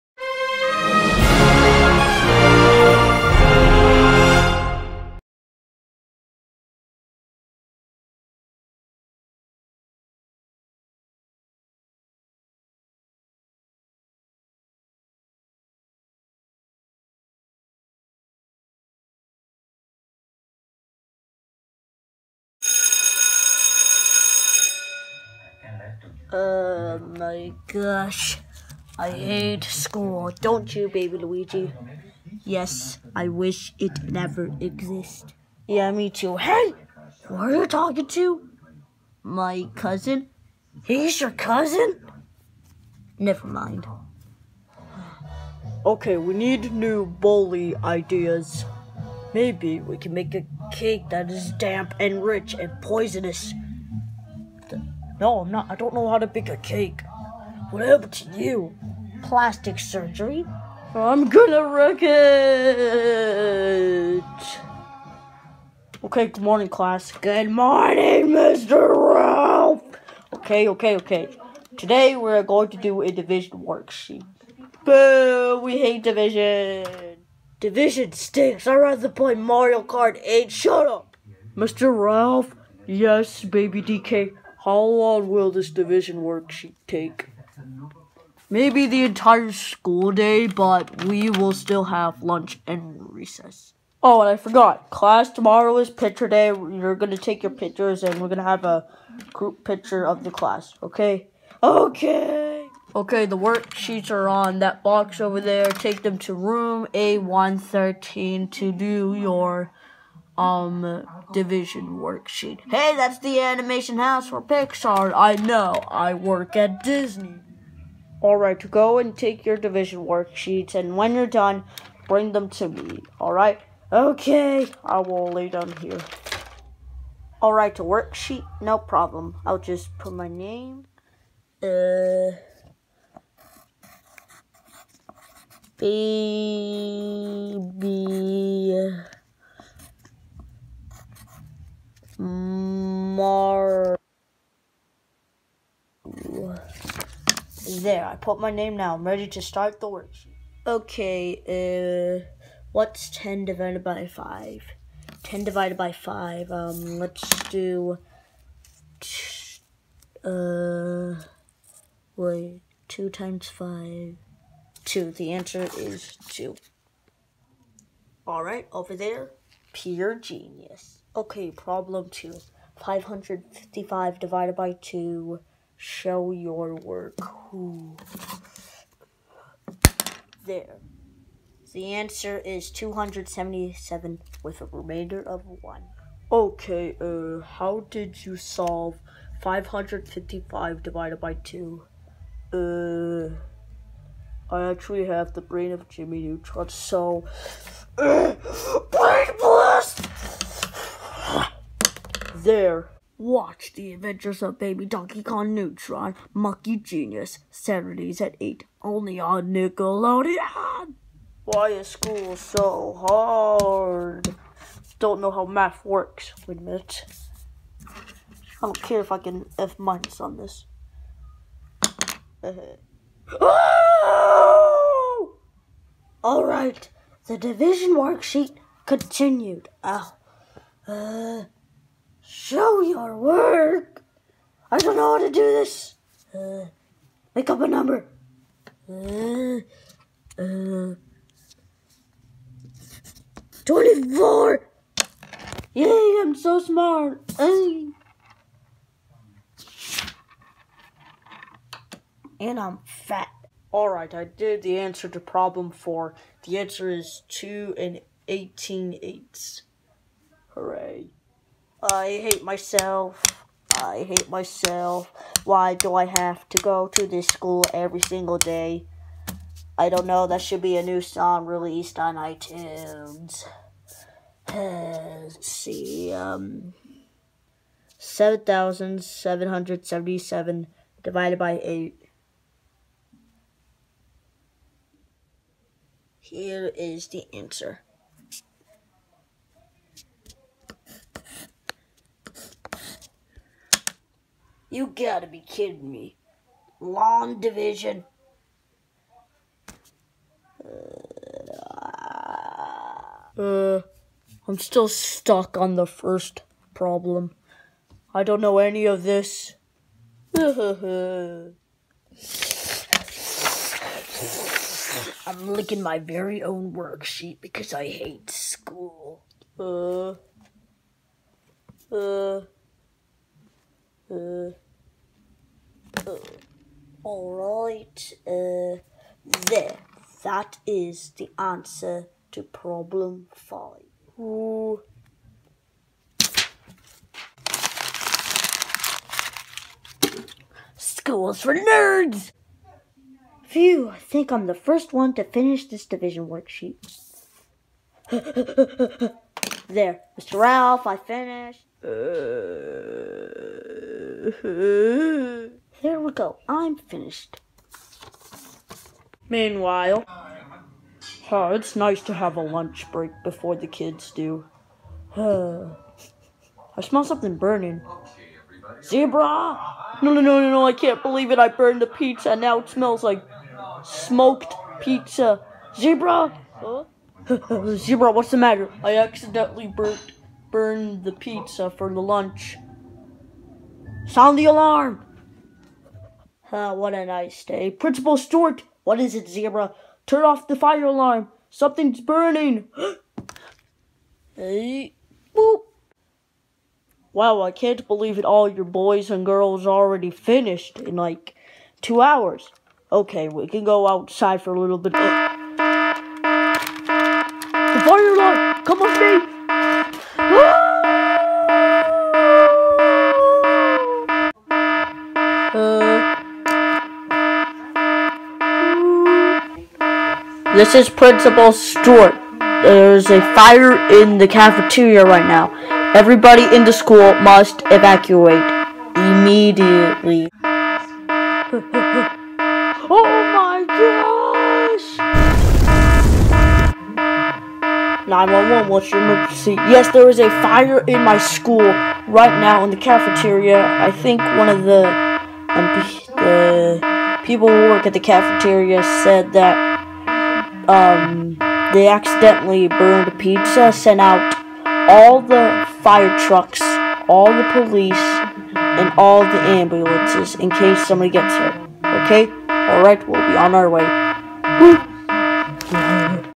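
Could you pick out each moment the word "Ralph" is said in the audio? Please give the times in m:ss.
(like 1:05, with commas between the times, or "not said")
1:09, 1:21, 5:50.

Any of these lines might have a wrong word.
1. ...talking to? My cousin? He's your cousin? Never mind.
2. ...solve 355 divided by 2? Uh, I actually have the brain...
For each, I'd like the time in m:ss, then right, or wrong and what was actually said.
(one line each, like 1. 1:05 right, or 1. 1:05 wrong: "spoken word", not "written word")
1. 0:37 right
2. 3:08 wrong: "555", not "355".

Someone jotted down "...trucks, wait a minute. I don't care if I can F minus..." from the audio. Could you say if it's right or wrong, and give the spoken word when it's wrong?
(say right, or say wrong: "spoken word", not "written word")
wrong: "works", not "trucks".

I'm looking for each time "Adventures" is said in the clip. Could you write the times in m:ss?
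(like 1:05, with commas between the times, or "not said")
3:23.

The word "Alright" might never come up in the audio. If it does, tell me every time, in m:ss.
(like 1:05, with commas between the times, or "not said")
2:48, 4:13, 5:27, 7:42.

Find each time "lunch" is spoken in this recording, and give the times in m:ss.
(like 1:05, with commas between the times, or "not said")
1:32, 6:02, 6:22.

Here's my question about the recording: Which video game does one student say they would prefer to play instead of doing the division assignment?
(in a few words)
Mario Kart 8.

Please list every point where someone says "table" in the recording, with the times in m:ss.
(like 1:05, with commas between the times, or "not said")
not said.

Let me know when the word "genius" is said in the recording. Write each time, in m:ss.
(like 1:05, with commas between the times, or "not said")
2:50, 3:26.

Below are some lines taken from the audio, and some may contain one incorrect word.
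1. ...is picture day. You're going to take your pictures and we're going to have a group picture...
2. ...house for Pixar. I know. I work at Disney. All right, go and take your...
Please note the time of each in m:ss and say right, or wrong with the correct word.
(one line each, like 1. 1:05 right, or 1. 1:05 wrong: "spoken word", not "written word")
1. 1:35 right
2. 1:53 right.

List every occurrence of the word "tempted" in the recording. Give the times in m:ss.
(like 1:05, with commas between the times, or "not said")
not said.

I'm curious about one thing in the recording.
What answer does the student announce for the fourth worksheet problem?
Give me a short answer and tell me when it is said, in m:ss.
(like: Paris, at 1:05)
2 and 18 eighths, at 4:17.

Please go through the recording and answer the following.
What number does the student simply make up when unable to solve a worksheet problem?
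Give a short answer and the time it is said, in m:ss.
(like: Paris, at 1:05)
24, at 4:03.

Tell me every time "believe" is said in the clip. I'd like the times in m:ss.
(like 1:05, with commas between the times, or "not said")
6:11, 6:37.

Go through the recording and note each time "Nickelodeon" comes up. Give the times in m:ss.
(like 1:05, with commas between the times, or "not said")
3:29.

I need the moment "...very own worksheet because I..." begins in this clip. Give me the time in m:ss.
5:15.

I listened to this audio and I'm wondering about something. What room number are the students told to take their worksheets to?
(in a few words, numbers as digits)
A113.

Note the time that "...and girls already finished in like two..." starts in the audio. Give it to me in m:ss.
6:39.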